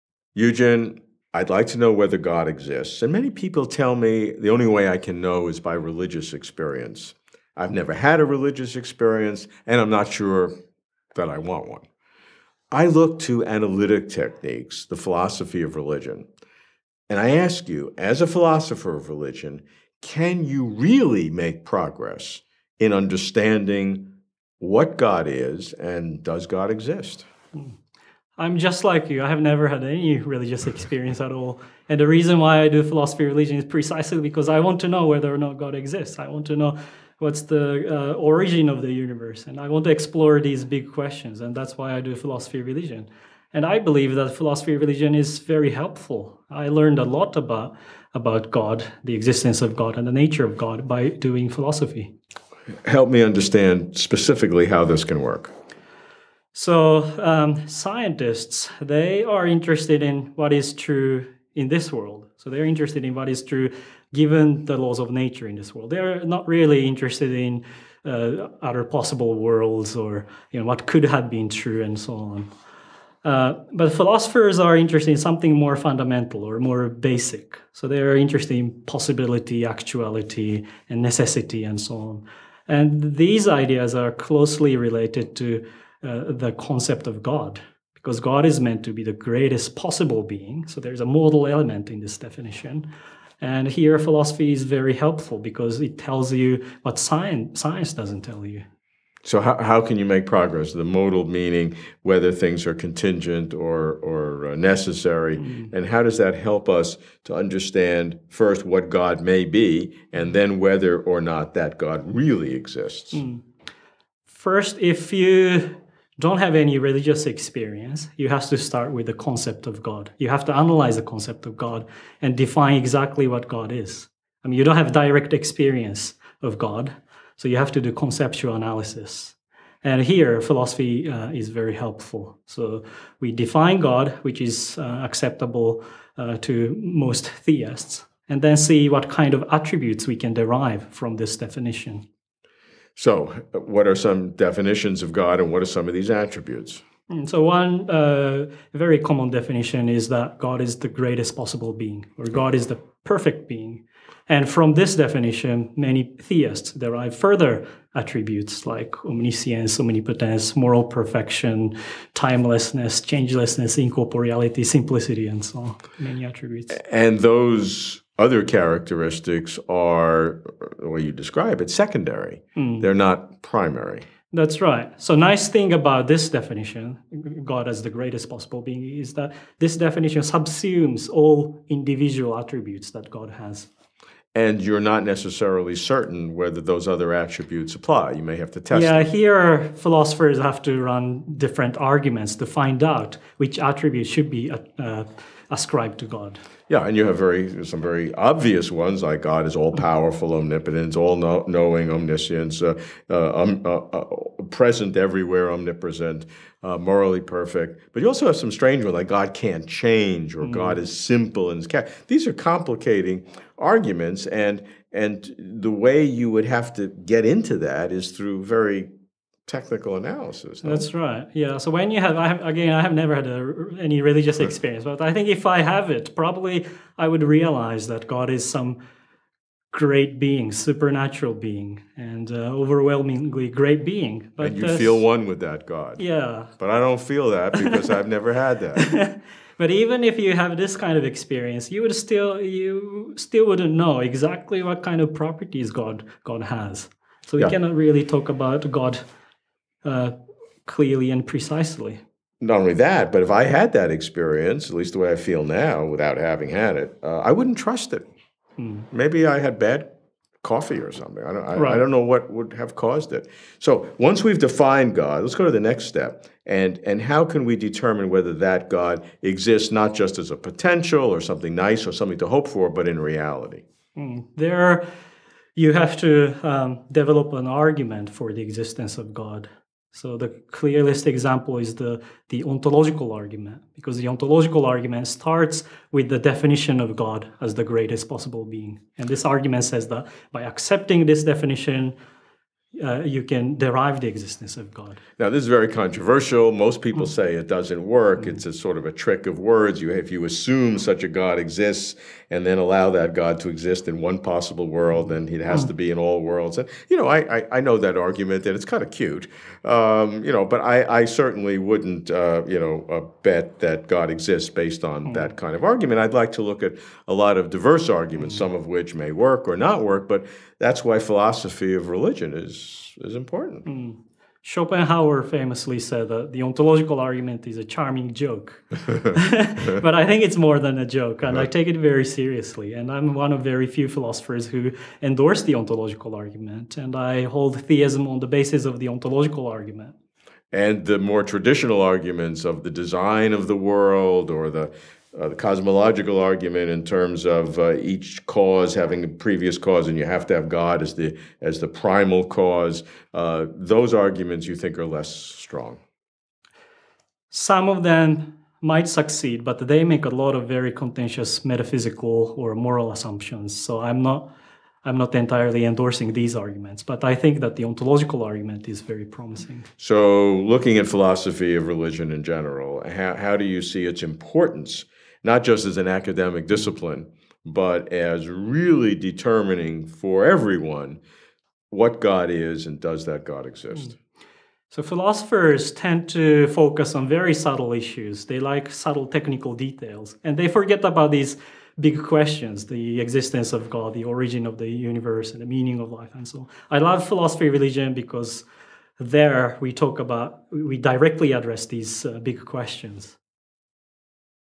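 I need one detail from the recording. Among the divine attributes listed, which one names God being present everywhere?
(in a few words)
Omnipresent.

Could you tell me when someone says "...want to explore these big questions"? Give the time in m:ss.
0:39.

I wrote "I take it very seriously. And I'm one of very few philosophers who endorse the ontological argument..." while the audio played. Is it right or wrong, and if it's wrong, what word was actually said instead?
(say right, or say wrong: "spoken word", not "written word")
right.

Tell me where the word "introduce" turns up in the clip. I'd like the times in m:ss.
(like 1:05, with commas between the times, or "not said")
not said.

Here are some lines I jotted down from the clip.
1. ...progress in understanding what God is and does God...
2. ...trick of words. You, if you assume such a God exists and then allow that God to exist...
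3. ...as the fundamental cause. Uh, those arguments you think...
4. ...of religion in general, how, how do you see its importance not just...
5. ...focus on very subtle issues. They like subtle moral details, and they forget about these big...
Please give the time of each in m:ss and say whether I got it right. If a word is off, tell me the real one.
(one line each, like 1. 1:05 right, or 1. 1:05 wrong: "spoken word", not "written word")
1. 0:21 right
2. 4:58 right
3. 5:51 wrong: "primal", not "fundamental"
4. 6:11 right
5. 6:26 wrong: "technical", not "moral".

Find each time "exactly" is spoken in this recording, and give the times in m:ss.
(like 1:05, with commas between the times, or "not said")
2:02, 4:03.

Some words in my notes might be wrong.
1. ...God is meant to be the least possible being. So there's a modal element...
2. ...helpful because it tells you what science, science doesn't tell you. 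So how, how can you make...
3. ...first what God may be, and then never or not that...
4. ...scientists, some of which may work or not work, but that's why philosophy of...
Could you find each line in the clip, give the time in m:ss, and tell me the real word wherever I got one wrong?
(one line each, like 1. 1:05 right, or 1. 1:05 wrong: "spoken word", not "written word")
1. 1:28 wrong: "greatest", not "least"
2. 1:34 right
3. 1:48 wrong: "whether", not "never"
4. 5:17 wrong: "arguments", not "scientists".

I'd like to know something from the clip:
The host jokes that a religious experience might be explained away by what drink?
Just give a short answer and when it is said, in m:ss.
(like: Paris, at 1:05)
Bad coffee, at 4:19.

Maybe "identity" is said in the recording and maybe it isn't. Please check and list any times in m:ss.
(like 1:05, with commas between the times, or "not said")
not said.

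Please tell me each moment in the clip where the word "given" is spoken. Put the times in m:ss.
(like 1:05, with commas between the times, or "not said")
1:04.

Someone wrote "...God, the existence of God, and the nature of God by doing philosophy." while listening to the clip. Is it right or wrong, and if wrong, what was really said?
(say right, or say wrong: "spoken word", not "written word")
right.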